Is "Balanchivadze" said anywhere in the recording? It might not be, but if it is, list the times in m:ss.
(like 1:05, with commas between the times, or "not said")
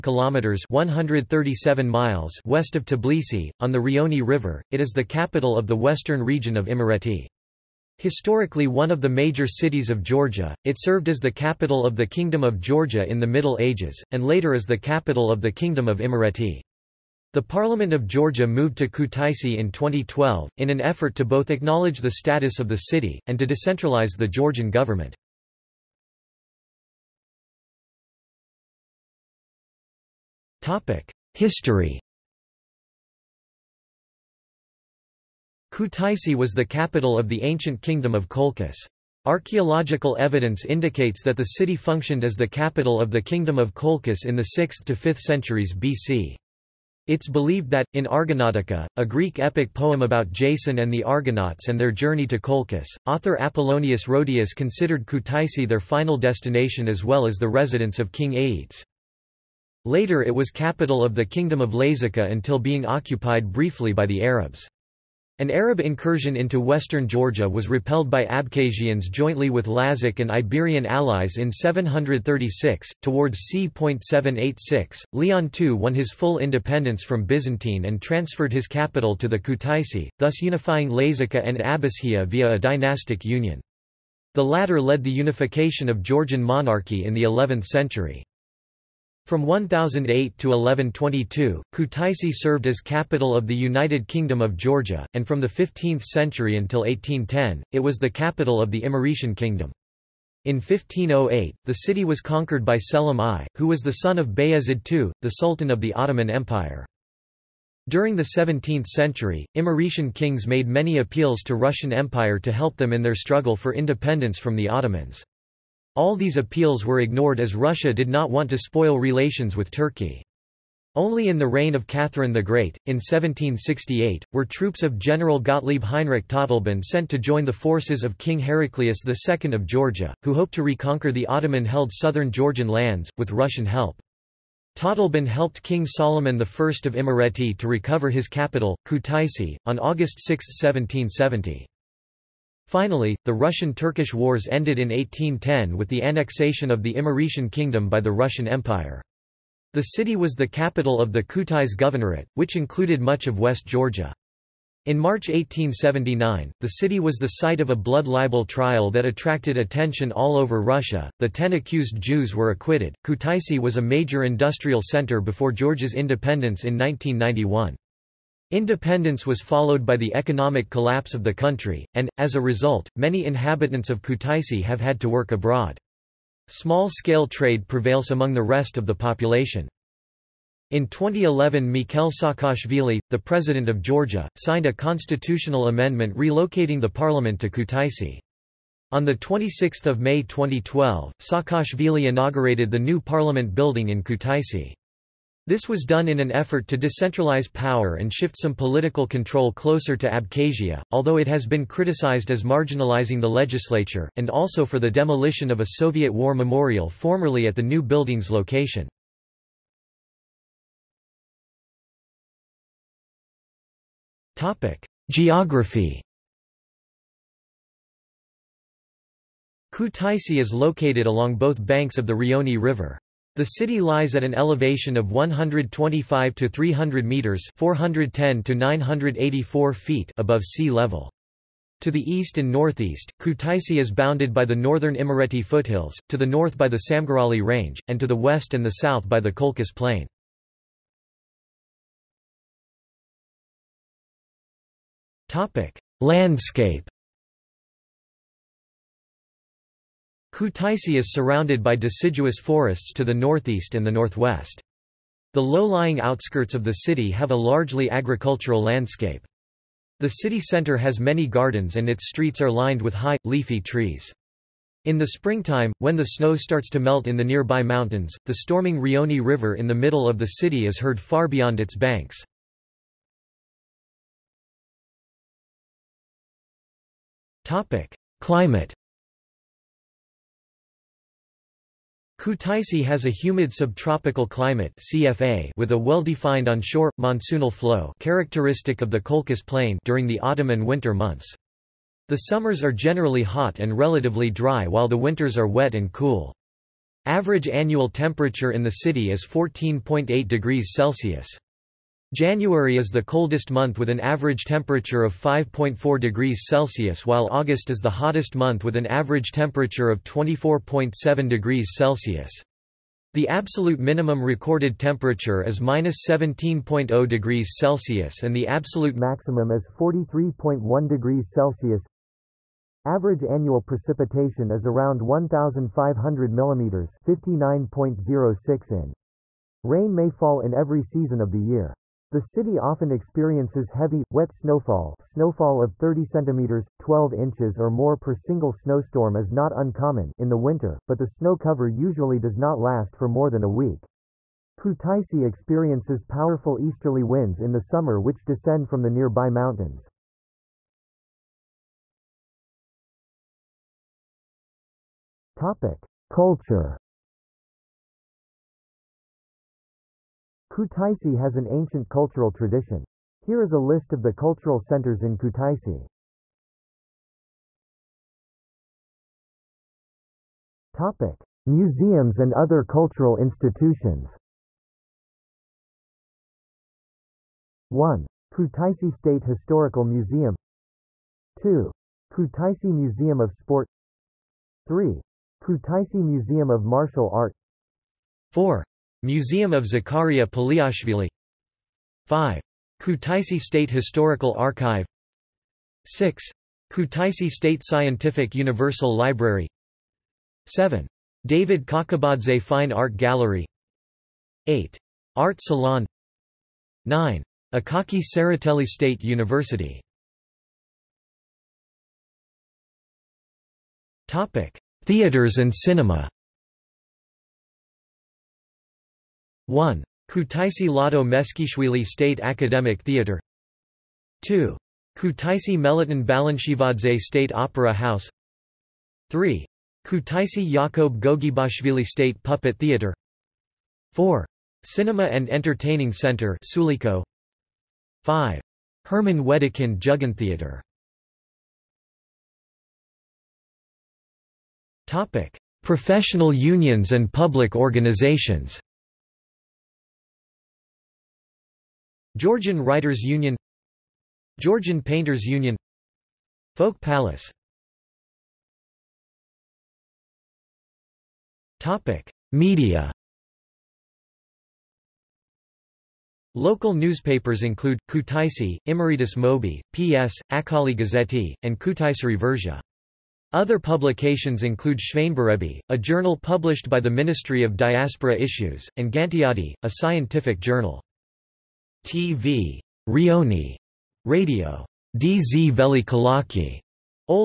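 7:06.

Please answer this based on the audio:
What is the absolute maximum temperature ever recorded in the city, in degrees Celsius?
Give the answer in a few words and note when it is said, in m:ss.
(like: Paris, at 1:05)
43.1, at 5:19.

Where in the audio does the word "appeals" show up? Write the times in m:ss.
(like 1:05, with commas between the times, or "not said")
1:50, 1:56.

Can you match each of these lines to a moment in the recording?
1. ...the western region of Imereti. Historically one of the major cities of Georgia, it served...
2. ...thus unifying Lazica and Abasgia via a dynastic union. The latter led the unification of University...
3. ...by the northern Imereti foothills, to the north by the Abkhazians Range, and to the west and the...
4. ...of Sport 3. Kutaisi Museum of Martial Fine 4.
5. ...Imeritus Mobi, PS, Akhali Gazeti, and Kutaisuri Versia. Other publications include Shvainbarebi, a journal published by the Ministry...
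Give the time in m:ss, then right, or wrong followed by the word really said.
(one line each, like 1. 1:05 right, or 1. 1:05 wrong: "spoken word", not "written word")
1. 0:05 right
2. 1:20 wrong: "Georgian", not "University"
3. 3:54 wrong: "Samgurali", not "Abkhazians"
4. 6:23 wrong: "Art", not "Fine"
5. 7:48 right.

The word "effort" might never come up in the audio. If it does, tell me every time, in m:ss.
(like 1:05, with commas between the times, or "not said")
0:20, 3:16.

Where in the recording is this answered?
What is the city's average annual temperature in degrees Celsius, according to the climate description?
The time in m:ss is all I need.
4:59.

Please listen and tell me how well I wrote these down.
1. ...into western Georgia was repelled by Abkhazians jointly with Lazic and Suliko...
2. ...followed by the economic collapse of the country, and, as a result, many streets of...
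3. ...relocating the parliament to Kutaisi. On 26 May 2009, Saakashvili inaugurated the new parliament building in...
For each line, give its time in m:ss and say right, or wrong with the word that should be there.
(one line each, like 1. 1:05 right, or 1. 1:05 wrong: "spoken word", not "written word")
1. 1:06 wrong: "Iberian", not "Suliko"
2. 2:49 wrong: "inhabitants", not "streets"
3. 3:06 wrong: "2012", not "2009".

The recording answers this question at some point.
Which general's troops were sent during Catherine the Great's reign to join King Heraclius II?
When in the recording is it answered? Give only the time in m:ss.
2:05.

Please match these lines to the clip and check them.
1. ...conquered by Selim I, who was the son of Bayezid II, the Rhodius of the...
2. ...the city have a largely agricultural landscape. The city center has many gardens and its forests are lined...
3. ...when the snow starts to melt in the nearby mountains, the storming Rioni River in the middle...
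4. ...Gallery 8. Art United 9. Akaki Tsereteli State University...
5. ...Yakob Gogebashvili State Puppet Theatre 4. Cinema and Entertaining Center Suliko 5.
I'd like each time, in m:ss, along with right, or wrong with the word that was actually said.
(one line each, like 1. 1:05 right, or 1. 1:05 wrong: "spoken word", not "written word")
1. 1:42 wrong: "Sultan", not "Rhodius"
2. 4:16 wrong: "streets", not "forests"
3. 4:25 right
4. 6:42 wrong: "Salon", not "United"
5. 7:10 right.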